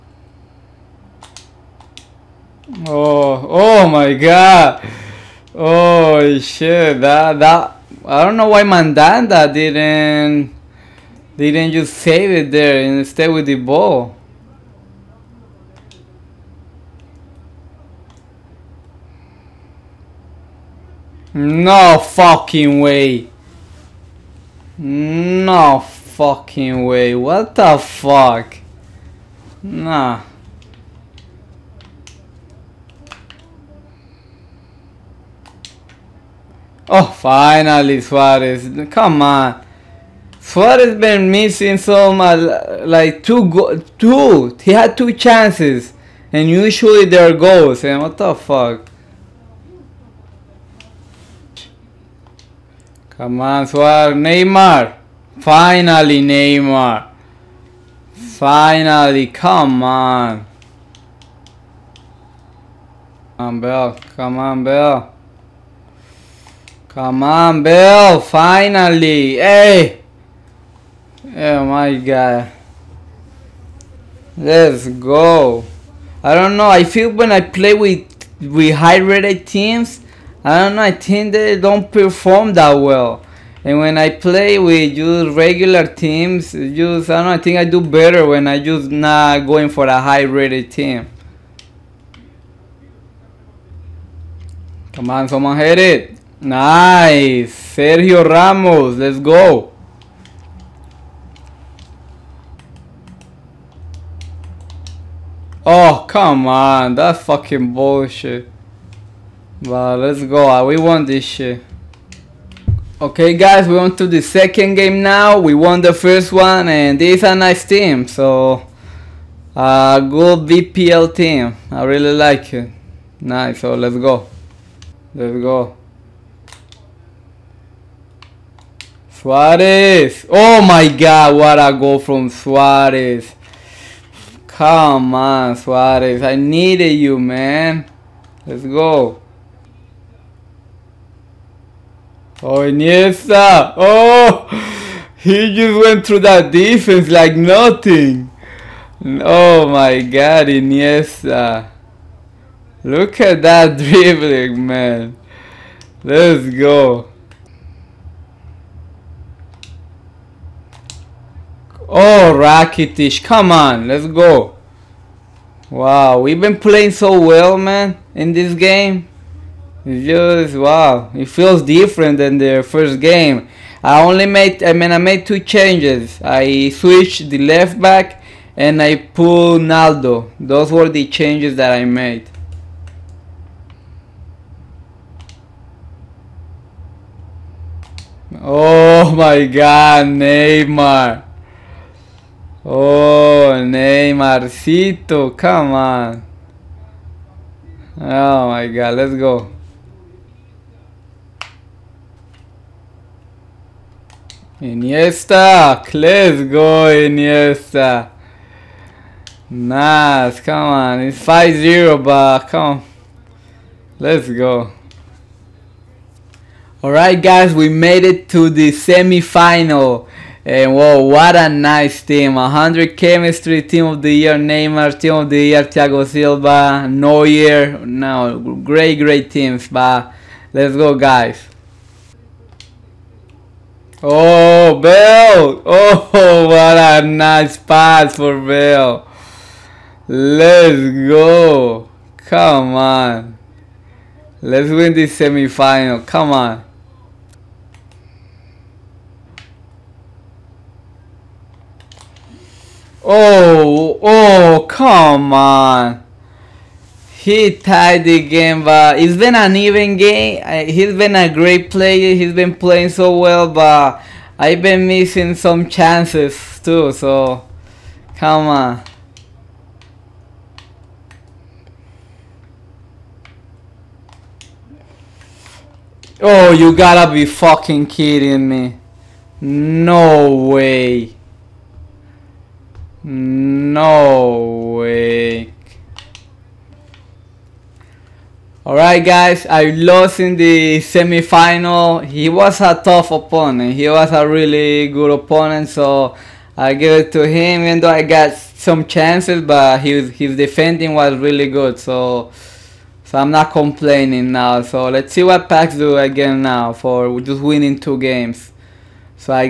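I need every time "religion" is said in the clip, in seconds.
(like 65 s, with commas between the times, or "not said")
not said.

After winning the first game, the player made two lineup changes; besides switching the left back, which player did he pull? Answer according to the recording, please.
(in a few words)
Naldo.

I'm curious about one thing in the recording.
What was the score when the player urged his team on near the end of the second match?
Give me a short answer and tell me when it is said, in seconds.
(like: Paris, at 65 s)
5-0, at 211 s.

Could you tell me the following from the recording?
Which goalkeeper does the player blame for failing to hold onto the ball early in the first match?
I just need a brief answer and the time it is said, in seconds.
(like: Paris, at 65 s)
Mandanda, at 8 s.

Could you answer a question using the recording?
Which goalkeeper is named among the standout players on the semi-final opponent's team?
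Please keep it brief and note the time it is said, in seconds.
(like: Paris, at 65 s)
Neuer, at 226 s.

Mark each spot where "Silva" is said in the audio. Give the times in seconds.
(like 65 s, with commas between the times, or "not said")
226 s.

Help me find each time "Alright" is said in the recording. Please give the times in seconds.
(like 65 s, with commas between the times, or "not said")
216 s, 288 s.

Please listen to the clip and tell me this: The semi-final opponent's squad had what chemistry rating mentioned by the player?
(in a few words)
100.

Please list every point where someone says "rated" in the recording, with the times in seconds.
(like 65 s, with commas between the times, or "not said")
78 s, 90 s.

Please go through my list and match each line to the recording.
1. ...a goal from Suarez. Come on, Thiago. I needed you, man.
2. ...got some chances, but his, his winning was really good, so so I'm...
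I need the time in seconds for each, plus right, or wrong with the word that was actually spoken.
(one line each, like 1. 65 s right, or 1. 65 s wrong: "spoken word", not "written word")
1. 131 s wrong: "Suarez", not "Thiago"
2. 298 s wrong: "defending", not "winning".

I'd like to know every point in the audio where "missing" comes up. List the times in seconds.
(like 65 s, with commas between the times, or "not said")
41 s, 264 s.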